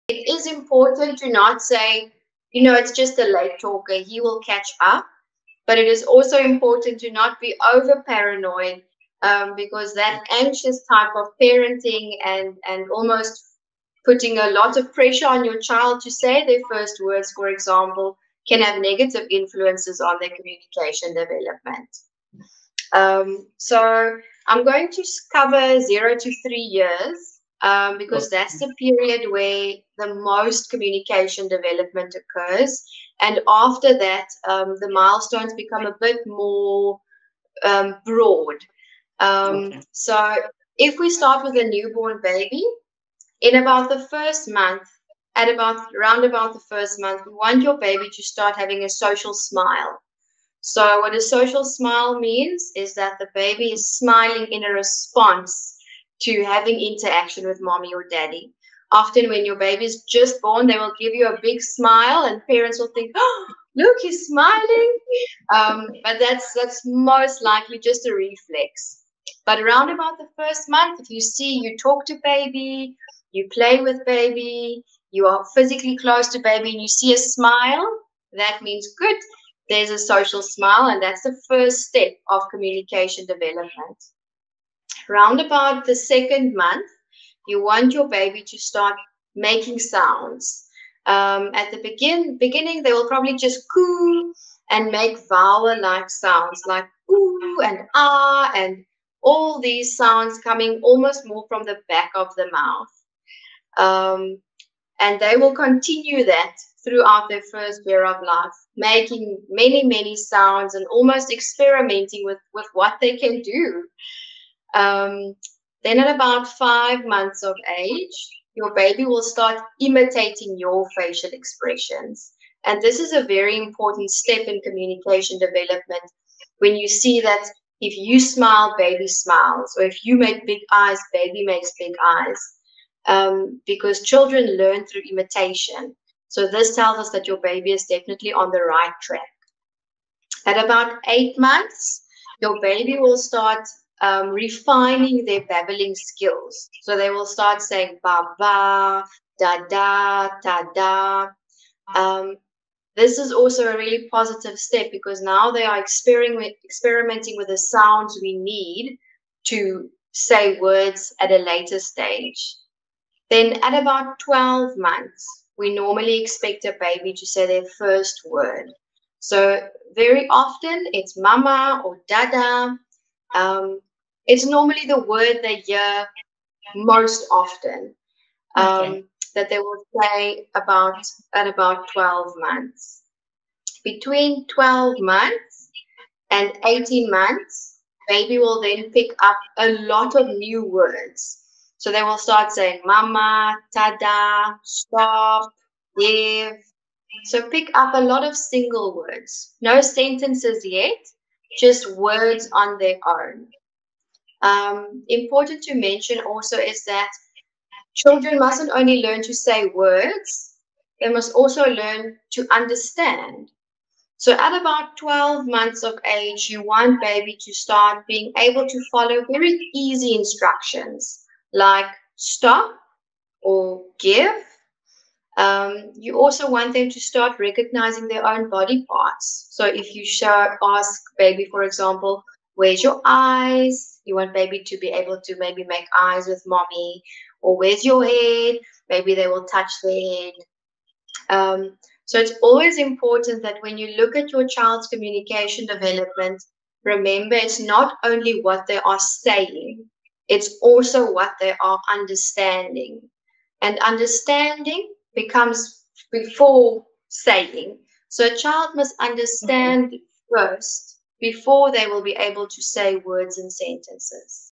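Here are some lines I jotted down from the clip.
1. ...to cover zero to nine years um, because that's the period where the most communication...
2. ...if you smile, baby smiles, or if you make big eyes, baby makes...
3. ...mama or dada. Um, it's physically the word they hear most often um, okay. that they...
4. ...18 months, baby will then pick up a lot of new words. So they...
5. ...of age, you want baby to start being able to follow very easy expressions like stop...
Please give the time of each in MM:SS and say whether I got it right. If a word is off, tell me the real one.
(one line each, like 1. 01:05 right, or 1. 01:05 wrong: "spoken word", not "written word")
1. 00:24 wrong: "three", not "nine"
2. 02:07 right
3. 02:51 wrong: "normally", not "physically"
4. 03:06 right
5. 03:35 wrong: "instructions", not "expressions".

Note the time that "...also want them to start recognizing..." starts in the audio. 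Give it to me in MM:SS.
03:46.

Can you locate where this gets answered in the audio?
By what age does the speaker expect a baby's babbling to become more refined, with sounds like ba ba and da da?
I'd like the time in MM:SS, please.
02:21.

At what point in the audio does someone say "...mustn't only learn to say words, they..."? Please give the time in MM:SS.
03:28.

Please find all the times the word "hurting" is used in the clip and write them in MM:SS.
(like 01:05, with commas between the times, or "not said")
not said.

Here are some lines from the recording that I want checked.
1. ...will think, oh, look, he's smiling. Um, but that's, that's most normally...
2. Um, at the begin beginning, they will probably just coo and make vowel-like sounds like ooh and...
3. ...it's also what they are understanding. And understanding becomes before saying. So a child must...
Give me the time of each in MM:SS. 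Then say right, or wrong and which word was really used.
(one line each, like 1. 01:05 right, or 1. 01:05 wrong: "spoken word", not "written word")
1. 01:02 wrong: "likely", not "normally"
2. 01:31 right
3. 04:10 right.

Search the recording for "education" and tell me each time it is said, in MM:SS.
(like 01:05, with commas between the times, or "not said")
not said.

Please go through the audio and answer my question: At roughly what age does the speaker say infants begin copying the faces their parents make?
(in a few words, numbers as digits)
5 months.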